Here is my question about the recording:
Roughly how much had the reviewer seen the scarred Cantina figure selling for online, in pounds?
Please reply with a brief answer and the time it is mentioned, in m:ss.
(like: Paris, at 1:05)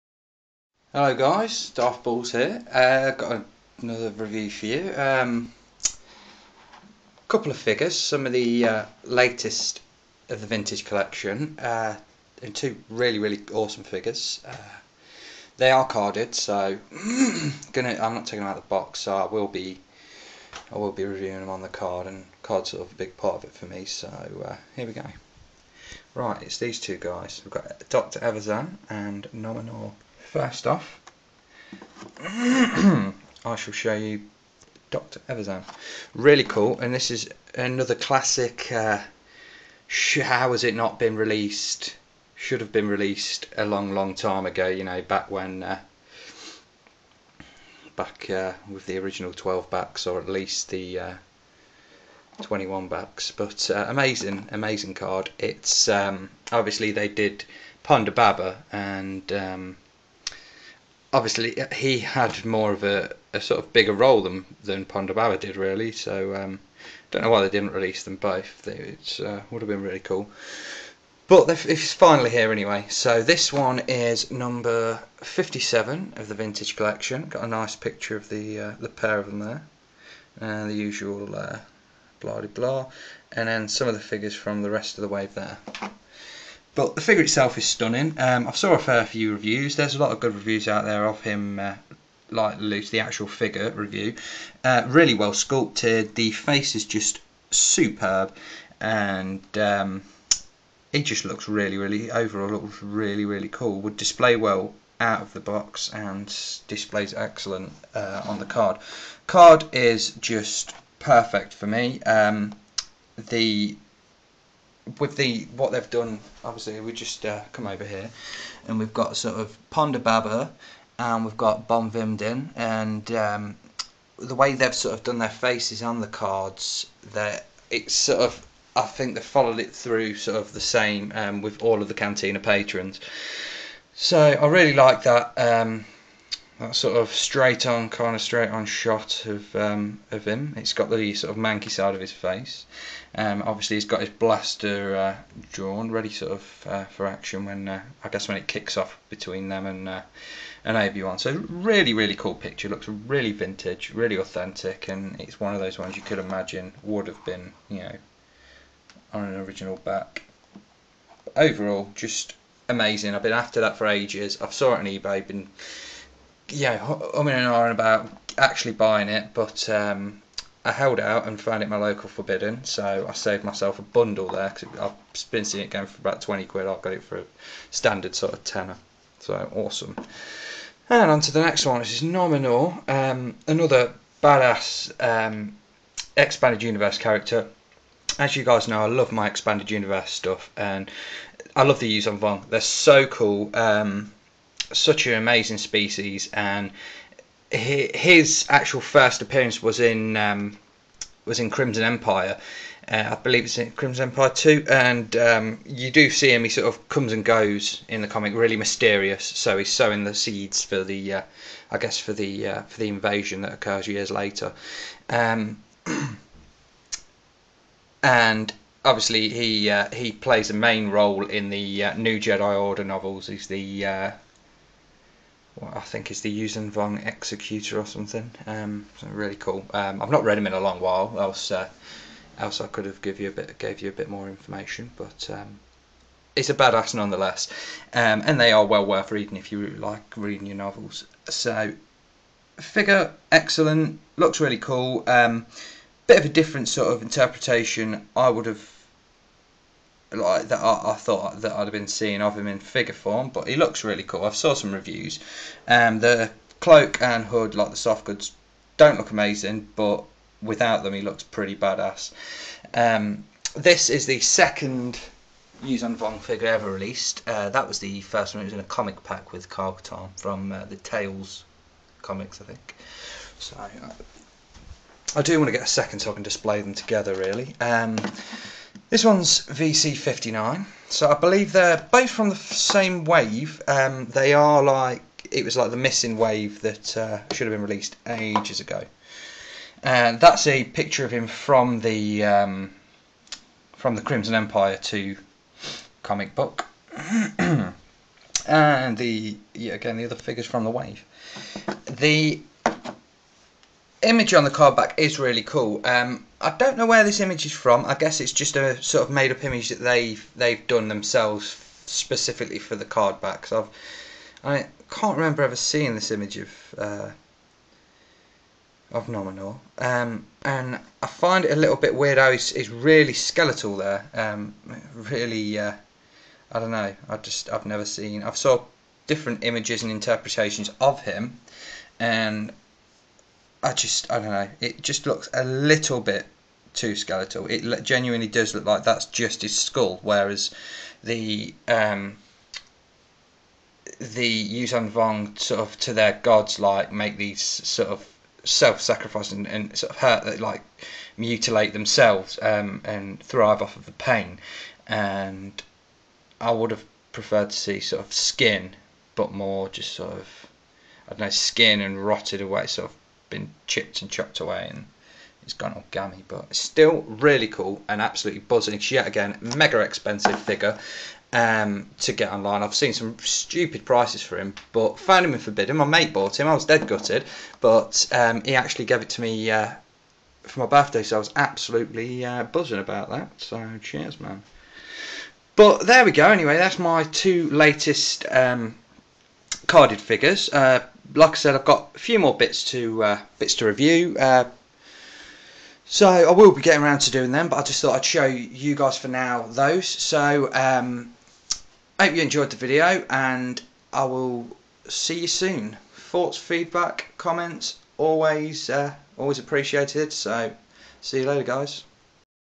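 20 quid, at 2:56.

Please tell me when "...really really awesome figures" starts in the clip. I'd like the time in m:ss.
0:12.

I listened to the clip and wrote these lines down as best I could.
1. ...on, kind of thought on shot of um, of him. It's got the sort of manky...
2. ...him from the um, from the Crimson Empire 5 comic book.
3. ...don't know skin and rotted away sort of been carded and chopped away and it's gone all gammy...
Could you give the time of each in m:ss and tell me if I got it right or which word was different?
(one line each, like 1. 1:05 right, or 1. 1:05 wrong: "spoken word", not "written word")
1. 2:17 wrong: "straight", not "thought"
2. 4:51 wrong: "2", not "5"
3. 6:01 wrong: "chipped", not "carded".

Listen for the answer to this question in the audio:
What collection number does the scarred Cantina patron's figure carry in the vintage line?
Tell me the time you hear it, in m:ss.
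1:14.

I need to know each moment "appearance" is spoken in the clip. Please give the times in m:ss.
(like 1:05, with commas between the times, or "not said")
3:19.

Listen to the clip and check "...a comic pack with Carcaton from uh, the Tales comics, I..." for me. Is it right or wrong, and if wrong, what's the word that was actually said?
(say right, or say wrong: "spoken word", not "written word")
right.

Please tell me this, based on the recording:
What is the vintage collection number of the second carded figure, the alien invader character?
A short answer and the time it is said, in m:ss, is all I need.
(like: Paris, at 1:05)
VC59, at 4:39.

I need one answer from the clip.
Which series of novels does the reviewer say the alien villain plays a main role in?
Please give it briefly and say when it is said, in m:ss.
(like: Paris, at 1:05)
New Jedi Order, at 3:41.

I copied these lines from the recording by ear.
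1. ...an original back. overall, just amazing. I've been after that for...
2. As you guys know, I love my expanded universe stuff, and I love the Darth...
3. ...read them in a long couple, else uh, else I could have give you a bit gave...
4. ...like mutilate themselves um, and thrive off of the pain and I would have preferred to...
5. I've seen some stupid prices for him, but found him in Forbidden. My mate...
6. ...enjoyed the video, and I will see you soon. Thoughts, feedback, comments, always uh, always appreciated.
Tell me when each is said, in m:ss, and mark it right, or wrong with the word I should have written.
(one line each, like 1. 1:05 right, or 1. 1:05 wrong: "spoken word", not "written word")
1. 2:39 right
2. 3:08 wrong: "Yuuzhan", not "Darth"
3. 3:50 wrong: "while", not "couple"
4. 5:50 right
5. 6:12 right
6. 6:42 right.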